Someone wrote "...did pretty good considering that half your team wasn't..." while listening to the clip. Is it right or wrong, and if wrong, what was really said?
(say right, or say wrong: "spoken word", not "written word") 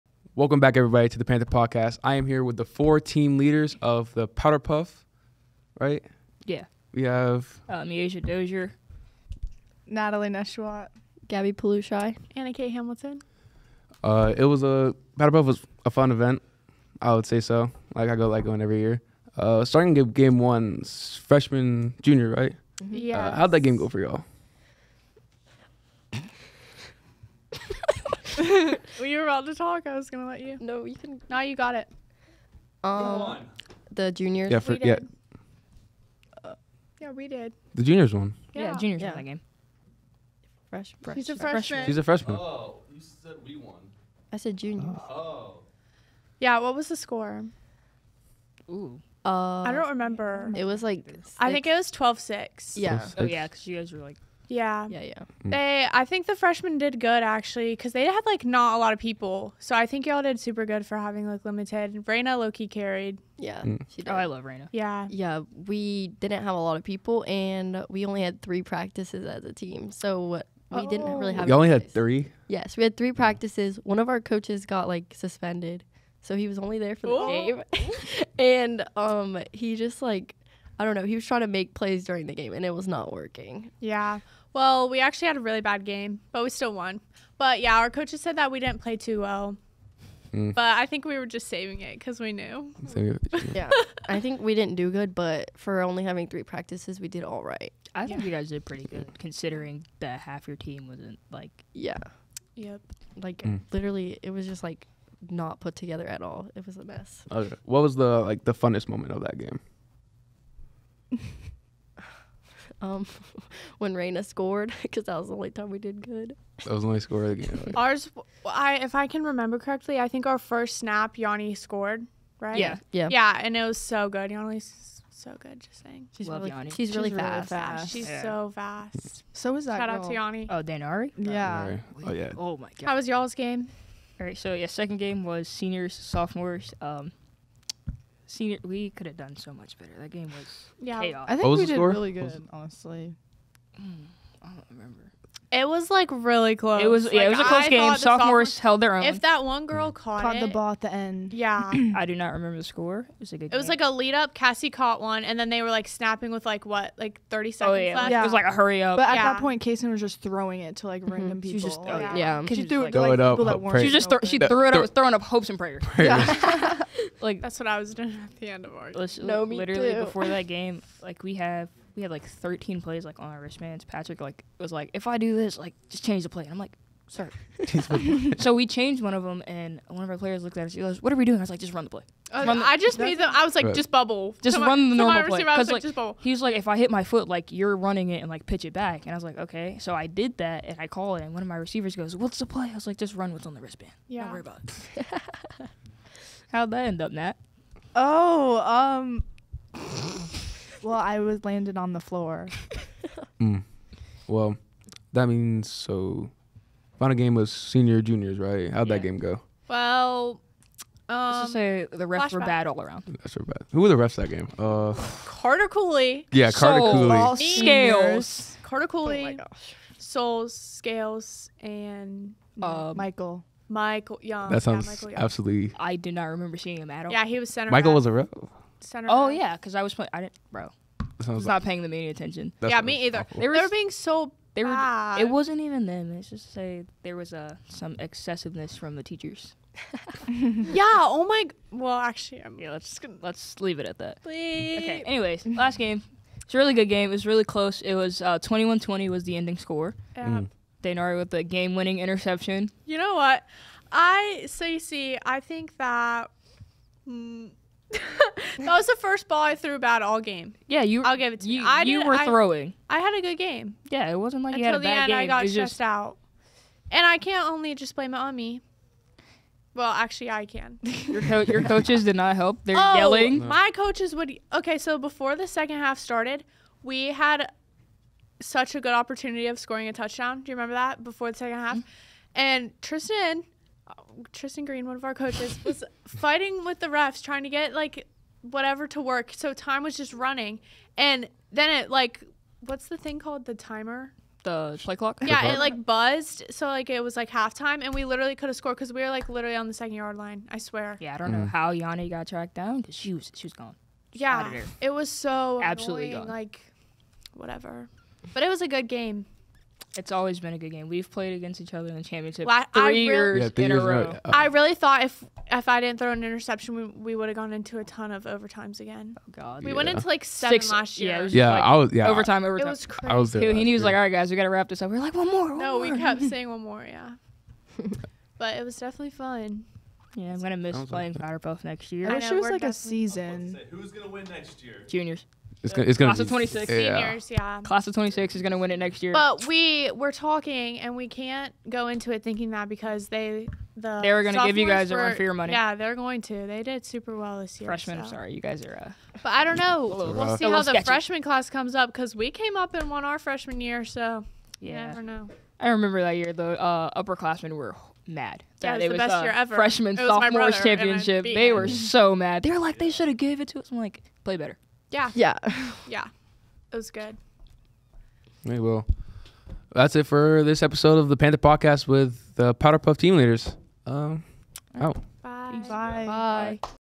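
right.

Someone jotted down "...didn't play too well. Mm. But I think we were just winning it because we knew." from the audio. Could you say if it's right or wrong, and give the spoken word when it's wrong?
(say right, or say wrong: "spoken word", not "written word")
wrong: "saving", not "winning".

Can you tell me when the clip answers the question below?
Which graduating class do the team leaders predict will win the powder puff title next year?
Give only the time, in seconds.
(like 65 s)
337 s.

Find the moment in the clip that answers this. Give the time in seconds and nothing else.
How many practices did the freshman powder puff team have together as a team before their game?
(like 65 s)
67 s.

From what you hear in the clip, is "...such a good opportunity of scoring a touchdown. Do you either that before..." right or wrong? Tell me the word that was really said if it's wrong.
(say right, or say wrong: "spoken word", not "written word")
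wrong: "remember", not "either".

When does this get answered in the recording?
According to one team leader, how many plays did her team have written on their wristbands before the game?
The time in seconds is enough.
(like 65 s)
172 s.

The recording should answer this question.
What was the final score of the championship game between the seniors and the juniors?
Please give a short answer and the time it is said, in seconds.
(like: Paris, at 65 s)
21-20, at 248 s.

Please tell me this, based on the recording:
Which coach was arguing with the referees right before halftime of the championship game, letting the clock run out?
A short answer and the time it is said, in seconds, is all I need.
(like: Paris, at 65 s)
Tristan Green, at 284 s.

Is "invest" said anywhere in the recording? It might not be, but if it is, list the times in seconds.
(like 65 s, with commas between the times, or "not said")
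not said.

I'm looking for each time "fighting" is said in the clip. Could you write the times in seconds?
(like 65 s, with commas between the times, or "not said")
286 s.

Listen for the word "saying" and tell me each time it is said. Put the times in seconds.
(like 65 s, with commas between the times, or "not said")
125 s, 326 s.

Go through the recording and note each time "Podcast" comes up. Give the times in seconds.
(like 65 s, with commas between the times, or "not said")
1 s, 371 s.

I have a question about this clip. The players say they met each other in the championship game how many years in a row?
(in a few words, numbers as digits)
3.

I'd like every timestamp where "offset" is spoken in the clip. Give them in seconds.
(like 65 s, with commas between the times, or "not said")
not said.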